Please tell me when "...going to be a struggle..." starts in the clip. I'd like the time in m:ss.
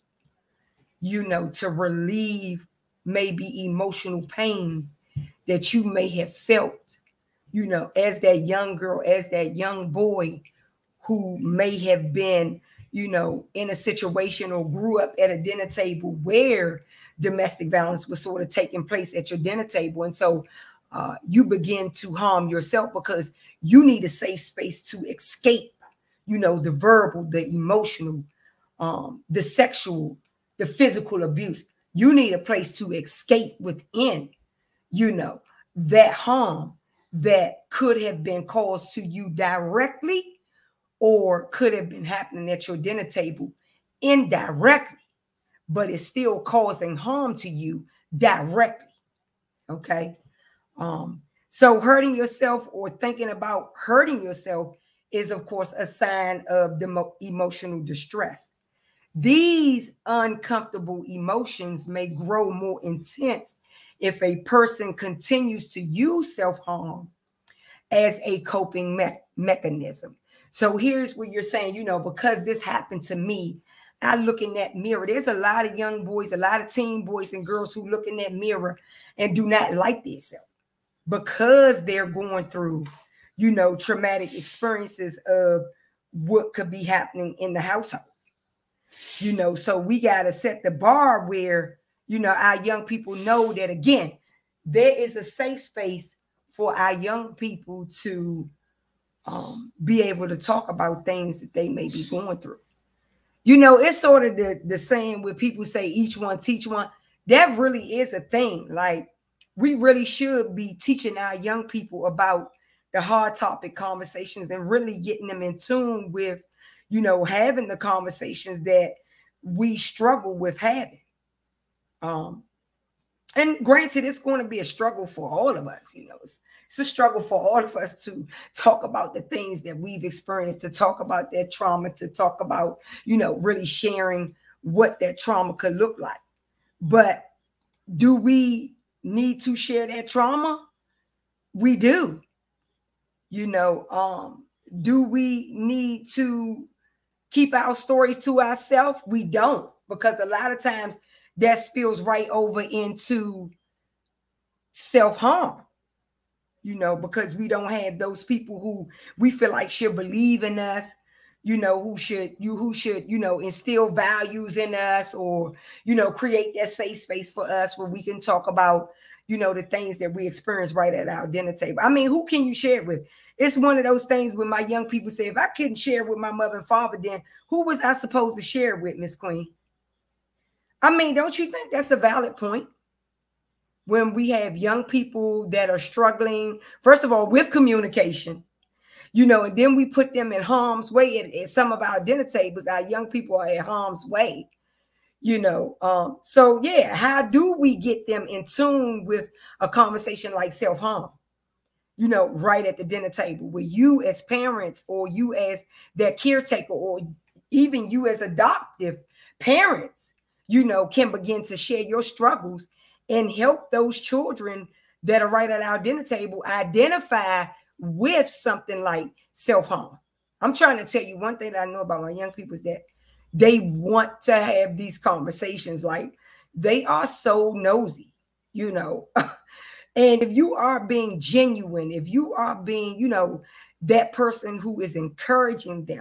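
2:04.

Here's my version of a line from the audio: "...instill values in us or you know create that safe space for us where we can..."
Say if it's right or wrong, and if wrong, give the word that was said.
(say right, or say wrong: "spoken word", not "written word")
right.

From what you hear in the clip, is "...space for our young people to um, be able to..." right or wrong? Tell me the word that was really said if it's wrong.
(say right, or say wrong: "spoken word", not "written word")
right.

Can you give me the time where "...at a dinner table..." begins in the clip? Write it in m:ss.
0:15.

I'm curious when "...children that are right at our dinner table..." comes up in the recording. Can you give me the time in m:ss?
3:33.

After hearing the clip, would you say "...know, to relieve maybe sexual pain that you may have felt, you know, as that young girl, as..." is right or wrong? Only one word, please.
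wrong.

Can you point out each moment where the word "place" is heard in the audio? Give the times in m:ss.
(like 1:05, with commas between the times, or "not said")
0:18, 0:32.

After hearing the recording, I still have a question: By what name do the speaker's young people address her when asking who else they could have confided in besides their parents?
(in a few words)
Miss Queen.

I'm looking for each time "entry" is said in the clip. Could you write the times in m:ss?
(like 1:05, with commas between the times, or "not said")
not said.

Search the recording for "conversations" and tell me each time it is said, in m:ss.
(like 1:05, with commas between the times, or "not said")
1:53, 1:57, 3:19, 3:44.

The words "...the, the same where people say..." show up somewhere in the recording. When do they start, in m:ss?
1:44.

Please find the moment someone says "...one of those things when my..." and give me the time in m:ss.
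2:53.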